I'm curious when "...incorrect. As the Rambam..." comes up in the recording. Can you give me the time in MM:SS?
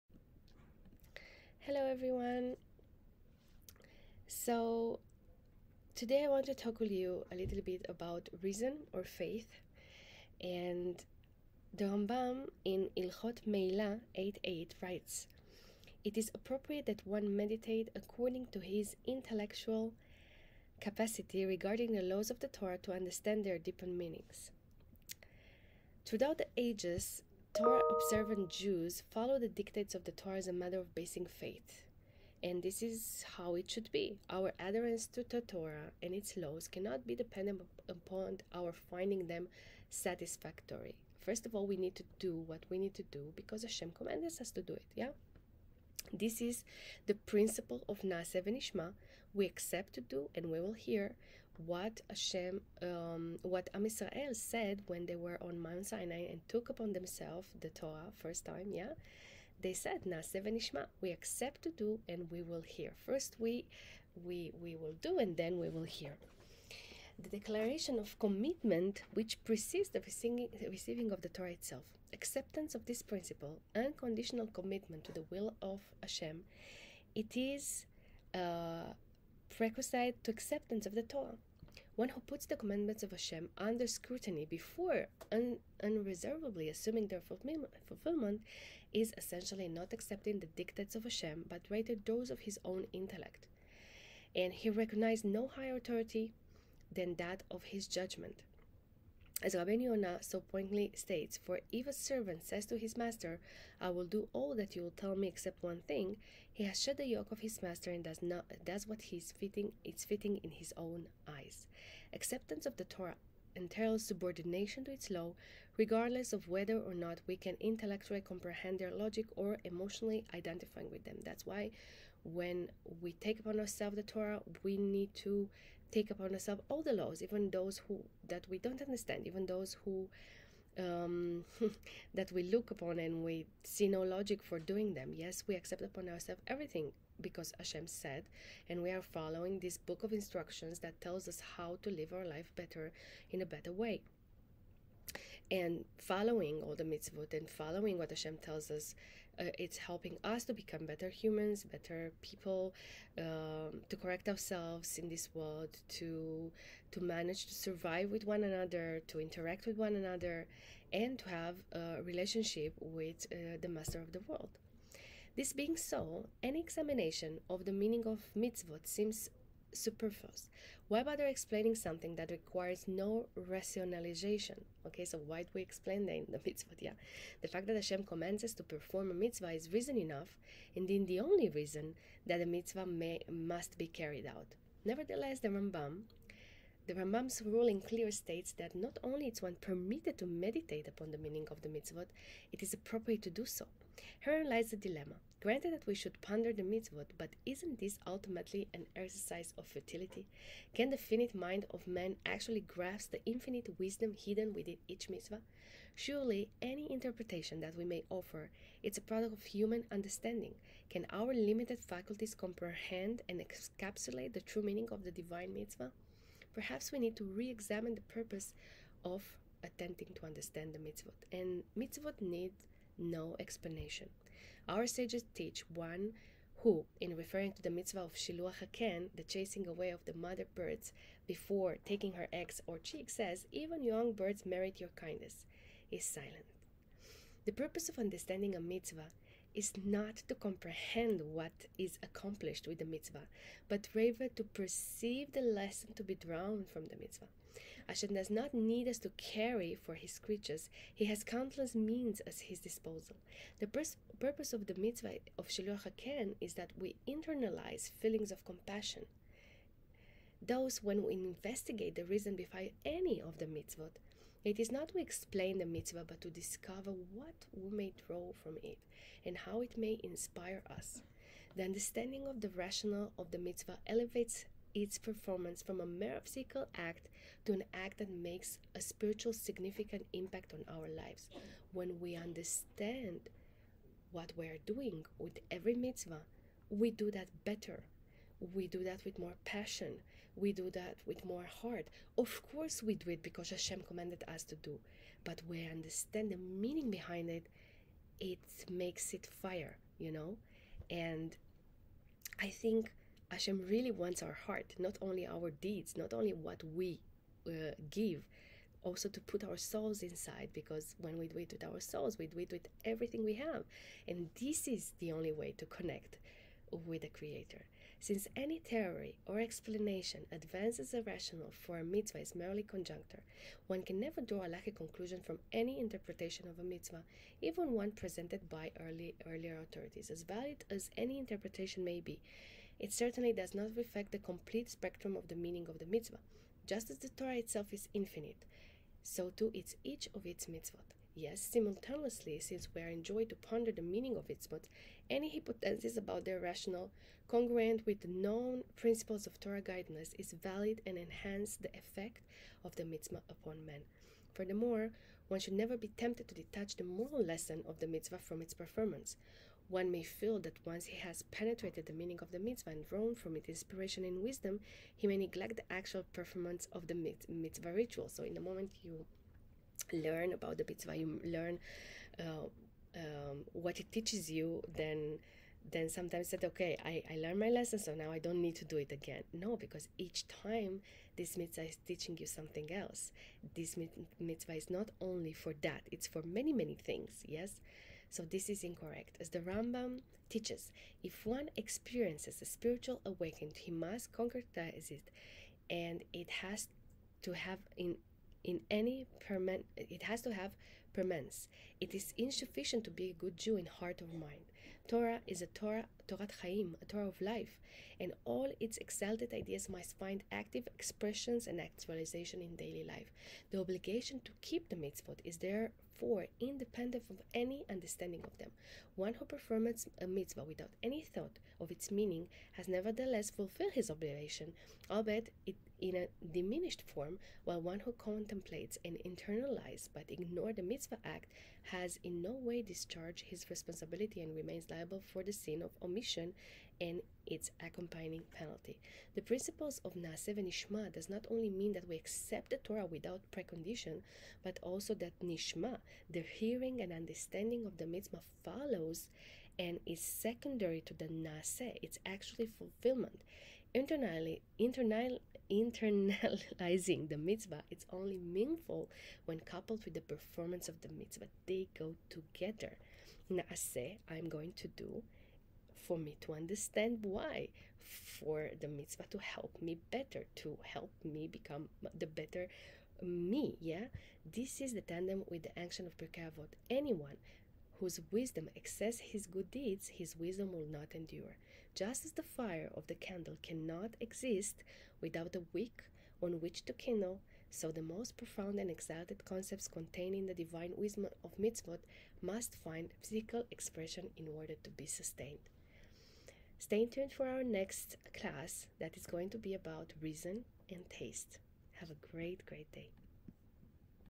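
06:28.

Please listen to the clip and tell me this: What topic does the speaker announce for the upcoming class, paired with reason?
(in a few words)
Reason and taste.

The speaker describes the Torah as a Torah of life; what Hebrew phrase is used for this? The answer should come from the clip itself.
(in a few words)
Torah Chaim.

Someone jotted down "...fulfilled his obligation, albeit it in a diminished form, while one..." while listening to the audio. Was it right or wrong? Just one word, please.
right.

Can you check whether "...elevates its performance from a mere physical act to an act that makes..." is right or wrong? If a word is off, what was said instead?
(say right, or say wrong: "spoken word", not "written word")
right.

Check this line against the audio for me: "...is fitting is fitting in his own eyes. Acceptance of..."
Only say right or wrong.
right.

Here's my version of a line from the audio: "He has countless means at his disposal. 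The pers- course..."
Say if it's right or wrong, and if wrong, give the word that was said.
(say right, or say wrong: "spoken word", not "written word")
wrong: "purpose", not "course".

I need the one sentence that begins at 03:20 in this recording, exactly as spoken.
Can the finite mind of man actually grasp the infinite wisdom hidden within each mitzvah?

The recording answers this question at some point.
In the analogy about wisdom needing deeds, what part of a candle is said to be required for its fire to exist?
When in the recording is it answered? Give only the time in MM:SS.
08:05.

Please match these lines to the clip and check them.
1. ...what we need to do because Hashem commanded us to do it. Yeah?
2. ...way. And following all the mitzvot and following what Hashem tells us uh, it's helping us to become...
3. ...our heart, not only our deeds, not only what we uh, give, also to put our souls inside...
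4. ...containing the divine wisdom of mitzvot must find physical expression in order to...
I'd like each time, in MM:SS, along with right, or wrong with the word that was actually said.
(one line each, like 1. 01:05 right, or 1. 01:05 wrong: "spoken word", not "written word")
1. 00:42 right
2. 02:23 right
3. 05:04 right
4. 08:09 right.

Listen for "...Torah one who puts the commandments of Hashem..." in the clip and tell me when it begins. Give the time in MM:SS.
01:21.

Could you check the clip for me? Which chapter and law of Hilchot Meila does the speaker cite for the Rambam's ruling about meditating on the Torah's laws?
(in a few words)
8.8.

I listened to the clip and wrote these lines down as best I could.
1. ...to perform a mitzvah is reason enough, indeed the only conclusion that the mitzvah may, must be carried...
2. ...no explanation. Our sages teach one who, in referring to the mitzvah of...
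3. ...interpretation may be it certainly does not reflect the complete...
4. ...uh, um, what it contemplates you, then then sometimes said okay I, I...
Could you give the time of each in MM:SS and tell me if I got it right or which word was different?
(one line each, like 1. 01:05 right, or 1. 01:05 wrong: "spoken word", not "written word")
1. 02:58 wrong: "reason", not "conclusion"
2. 03:42 right
3. 05:31 right
4. 06:12 wrong: "teaches", not "contemplates".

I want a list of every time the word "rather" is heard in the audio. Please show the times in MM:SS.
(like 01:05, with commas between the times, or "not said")
01:31, 04:03.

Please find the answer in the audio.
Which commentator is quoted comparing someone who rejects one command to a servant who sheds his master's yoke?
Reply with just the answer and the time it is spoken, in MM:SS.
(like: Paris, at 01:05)
Rabbeinu Yonah, at 01:39.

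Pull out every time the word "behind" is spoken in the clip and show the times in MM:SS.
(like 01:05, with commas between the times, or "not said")
04:22, 04:56.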